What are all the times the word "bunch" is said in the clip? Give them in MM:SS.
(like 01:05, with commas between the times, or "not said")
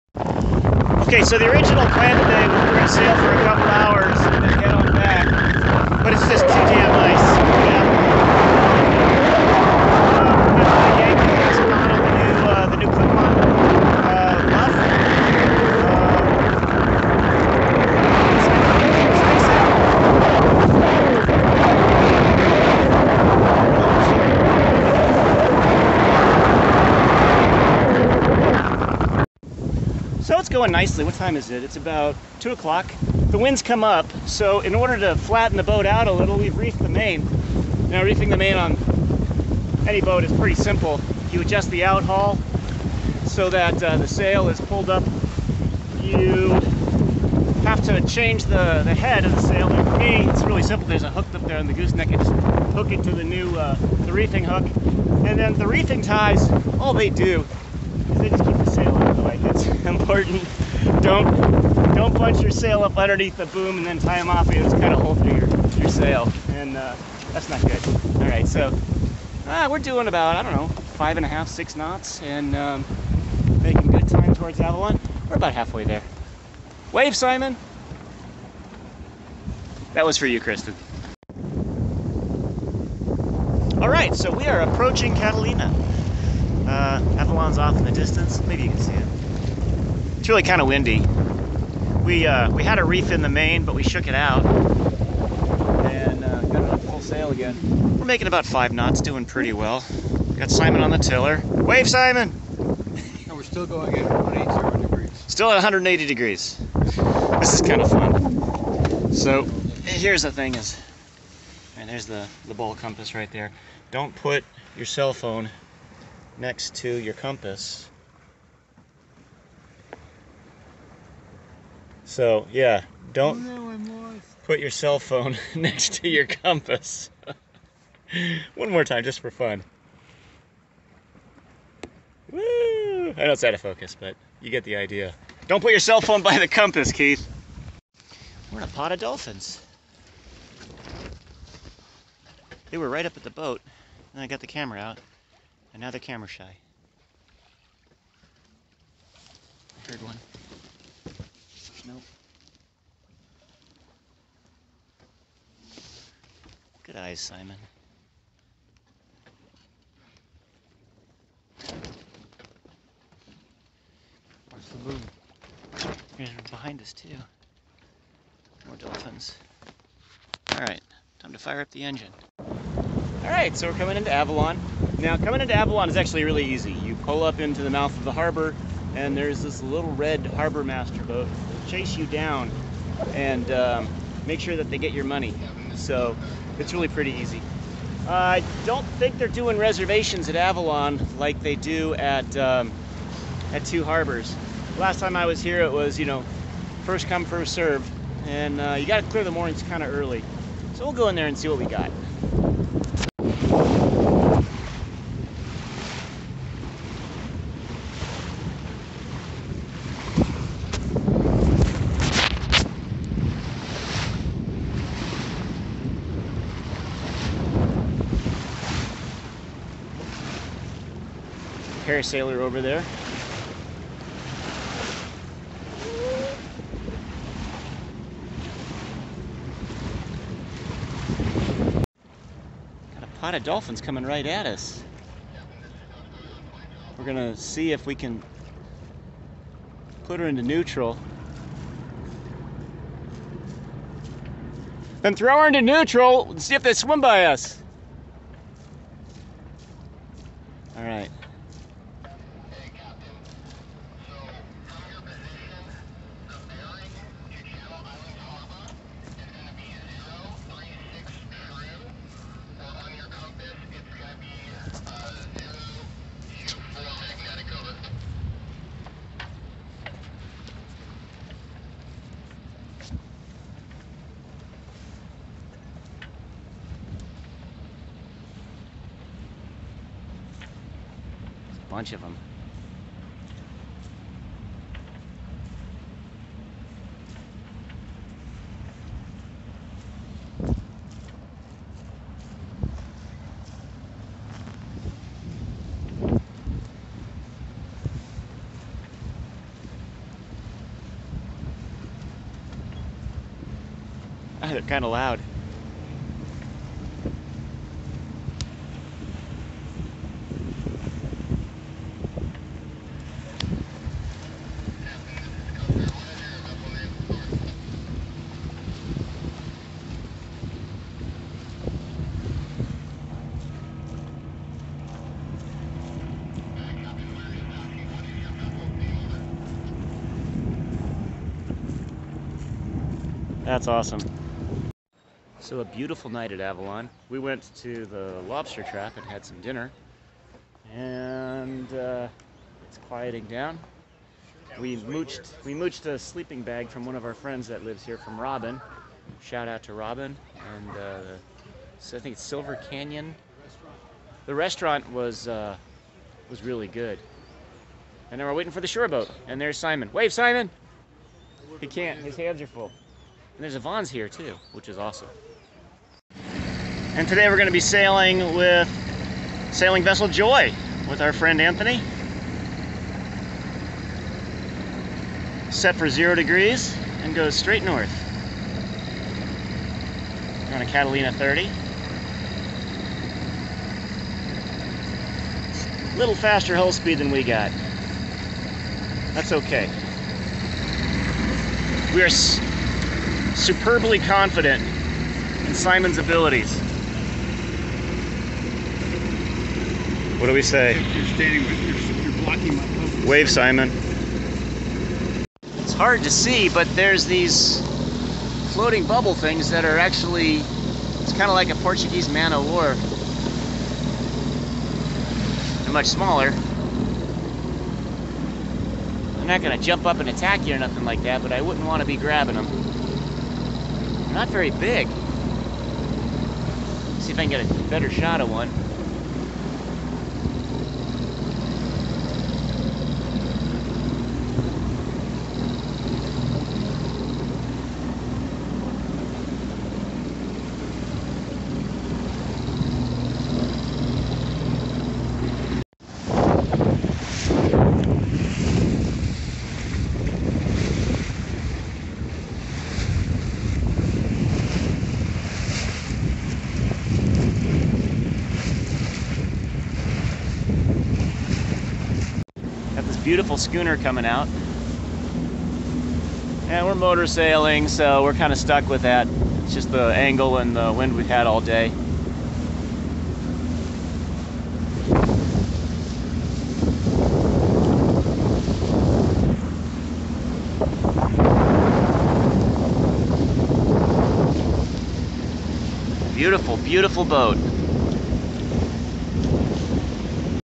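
01:02, 04:41.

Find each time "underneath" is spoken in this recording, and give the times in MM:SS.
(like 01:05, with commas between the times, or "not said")
01:02.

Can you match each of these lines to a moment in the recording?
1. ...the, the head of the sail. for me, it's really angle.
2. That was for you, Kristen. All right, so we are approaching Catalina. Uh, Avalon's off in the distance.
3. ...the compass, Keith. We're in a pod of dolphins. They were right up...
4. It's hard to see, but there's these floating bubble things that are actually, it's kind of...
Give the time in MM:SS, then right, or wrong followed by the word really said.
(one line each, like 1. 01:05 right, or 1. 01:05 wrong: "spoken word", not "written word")
1. 00:48 wrong: "simple", not "angle"
2. 01:19 right
3. 02:16 right
4. 06:45 right.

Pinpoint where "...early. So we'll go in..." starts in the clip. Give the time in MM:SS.
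03:19.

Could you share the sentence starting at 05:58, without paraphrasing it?
And then we're waiting for the shore boat.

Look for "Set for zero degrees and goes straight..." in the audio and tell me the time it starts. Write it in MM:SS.
06:15.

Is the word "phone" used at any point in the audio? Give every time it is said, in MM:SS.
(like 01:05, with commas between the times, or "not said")
01:55, 02:04, 02:16.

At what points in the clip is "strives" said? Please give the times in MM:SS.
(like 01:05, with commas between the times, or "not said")
not said.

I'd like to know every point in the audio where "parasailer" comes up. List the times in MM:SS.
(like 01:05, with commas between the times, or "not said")
03:41.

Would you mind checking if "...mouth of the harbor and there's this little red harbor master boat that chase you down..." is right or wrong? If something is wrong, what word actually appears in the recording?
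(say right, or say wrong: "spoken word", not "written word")
right.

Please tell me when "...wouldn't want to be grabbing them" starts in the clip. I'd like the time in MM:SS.
07:01.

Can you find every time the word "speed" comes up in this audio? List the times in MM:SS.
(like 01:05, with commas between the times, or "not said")
06:26.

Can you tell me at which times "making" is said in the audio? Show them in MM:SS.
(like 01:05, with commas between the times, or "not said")
01:13, 01:38.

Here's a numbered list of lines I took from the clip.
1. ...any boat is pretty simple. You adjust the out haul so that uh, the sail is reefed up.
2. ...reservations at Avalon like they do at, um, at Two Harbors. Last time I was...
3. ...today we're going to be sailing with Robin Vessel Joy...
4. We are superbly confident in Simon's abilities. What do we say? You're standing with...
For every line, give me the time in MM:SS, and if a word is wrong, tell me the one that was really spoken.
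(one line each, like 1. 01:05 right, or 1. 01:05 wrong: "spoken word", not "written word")
1. 00:39 wrong: "pulled", not "reefed"
2. 03:09 right
3. 06:07 wrong: "Sailing", not "Robin"
4. 06:31 right.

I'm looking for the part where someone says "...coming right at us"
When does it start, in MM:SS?
03:53.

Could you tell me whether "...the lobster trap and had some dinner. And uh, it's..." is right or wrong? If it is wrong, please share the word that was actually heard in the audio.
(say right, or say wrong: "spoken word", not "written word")
right.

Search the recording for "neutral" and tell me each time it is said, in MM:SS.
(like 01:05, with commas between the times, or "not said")
04:00, 04:05.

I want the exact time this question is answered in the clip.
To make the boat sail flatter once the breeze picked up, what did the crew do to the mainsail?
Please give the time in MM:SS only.
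00:36.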